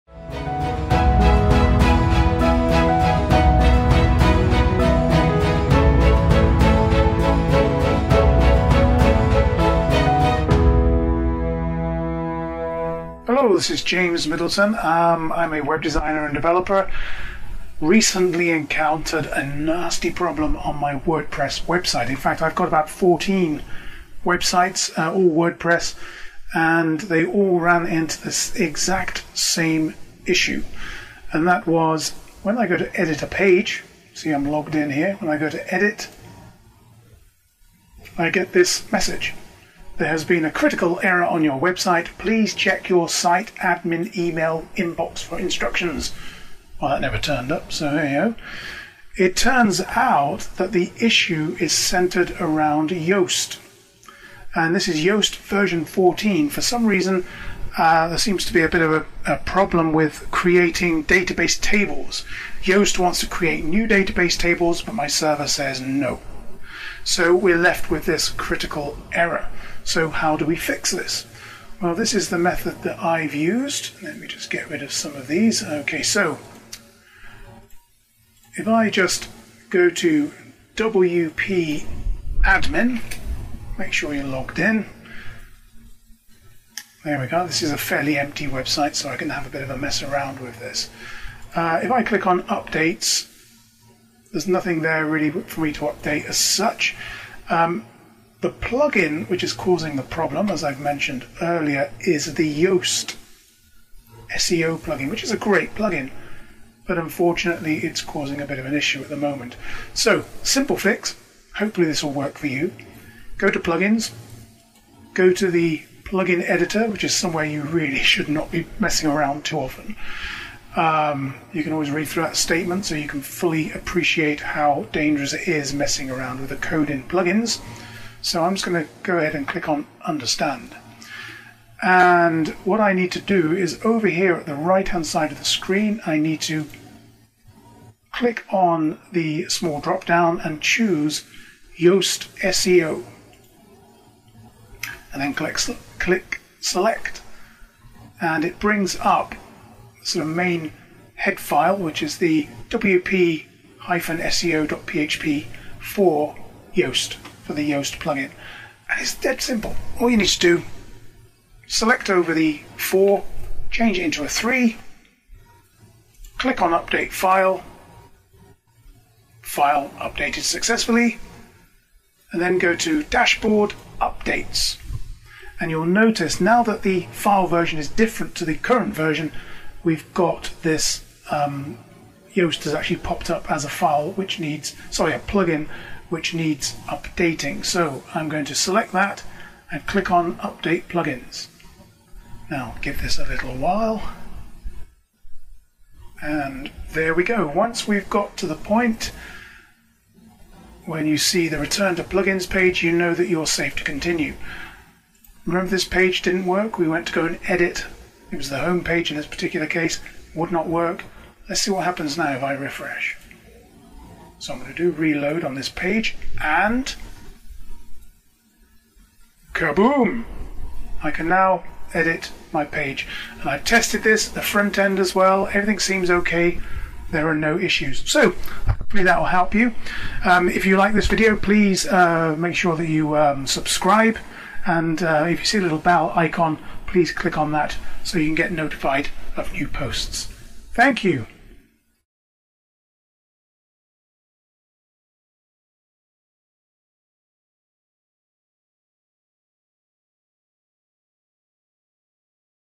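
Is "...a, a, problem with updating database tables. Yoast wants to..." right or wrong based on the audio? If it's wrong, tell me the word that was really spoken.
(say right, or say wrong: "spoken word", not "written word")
wrong: "creating", not "updating".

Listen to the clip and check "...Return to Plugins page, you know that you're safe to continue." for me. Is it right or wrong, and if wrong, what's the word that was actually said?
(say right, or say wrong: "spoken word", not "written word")
right.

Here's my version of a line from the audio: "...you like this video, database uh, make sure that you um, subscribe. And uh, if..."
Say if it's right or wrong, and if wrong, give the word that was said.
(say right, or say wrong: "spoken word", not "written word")
wrong: "please", not "database".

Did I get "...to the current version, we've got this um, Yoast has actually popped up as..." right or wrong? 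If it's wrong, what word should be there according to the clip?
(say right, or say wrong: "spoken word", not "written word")
right.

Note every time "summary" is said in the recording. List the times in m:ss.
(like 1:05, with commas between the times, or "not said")
not said.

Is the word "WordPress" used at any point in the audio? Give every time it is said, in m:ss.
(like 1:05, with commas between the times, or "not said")
0:20, 0:25.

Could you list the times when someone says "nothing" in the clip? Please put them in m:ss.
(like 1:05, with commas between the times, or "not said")
1:34.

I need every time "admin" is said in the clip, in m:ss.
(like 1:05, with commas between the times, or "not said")
0:43, 1:22.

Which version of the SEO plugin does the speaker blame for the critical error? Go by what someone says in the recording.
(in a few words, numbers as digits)
14.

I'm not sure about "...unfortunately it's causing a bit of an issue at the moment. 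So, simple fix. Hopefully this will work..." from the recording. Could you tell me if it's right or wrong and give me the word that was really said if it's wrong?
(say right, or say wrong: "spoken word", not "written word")
right.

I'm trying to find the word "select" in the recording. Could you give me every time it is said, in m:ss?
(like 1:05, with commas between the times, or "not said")
2:26, 2:41, 3:08.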